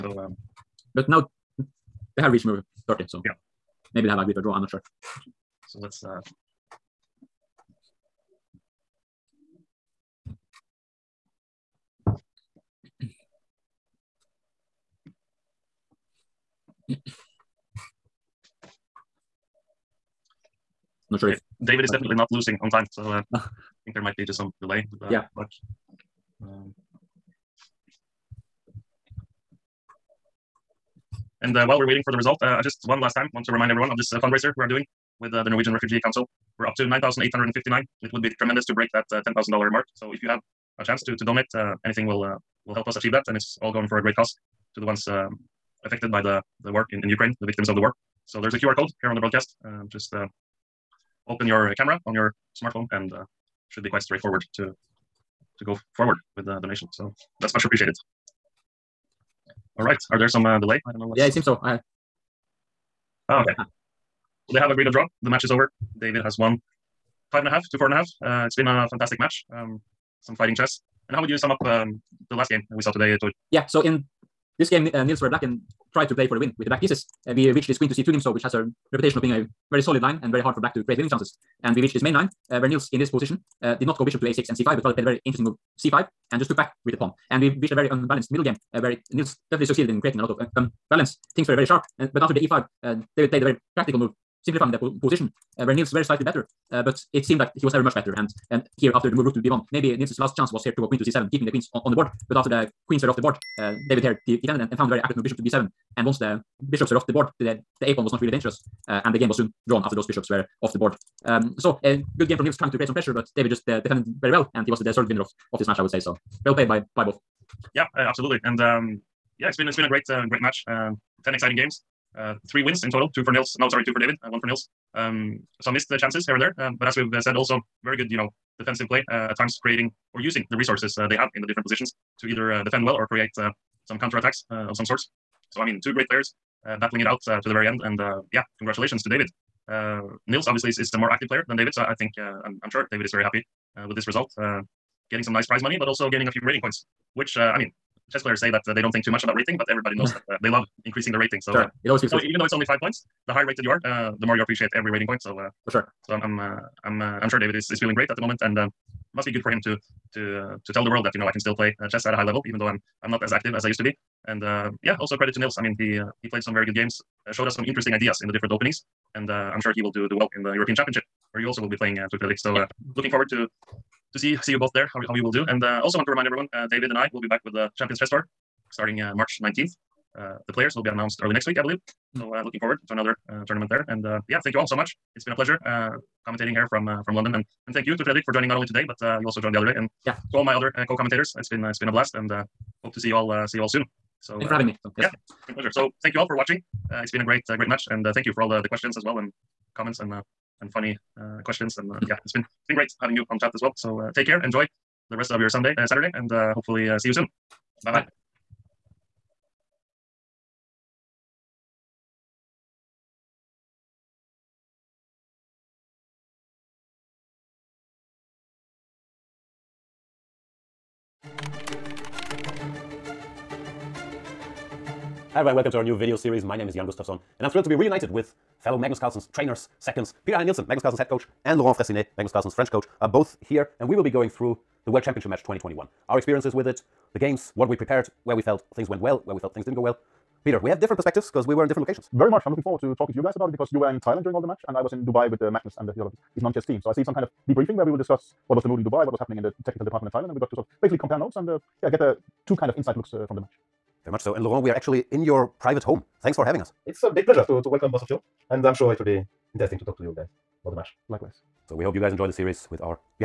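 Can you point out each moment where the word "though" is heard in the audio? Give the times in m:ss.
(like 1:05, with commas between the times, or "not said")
2:32, 2:42.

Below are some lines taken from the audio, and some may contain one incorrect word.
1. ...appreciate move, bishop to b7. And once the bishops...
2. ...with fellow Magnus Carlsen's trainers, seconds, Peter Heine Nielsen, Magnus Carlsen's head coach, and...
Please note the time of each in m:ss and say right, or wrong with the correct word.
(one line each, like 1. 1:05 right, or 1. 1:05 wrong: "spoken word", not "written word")
1. 1:44 wrong: "accurate", not "appreciate"
2. 3:48 right.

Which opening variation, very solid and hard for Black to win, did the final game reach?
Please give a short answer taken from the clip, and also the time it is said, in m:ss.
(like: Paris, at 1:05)
Queen to c2 Nimzo, at 1:17.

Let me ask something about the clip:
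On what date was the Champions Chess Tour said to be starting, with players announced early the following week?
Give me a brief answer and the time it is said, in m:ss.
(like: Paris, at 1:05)
March 19th, at 2:59.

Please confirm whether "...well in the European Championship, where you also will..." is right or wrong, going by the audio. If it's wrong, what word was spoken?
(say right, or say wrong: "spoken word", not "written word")
right.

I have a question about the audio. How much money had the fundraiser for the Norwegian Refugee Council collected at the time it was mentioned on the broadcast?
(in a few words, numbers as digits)
9,859.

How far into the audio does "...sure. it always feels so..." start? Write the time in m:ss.
2:31.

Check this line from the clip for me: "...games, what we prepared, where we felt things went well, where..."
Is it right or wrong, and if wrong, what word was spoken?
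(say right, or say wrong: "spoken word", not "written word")
right.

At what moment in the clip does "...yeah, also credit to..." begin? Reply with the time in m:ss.
2:44.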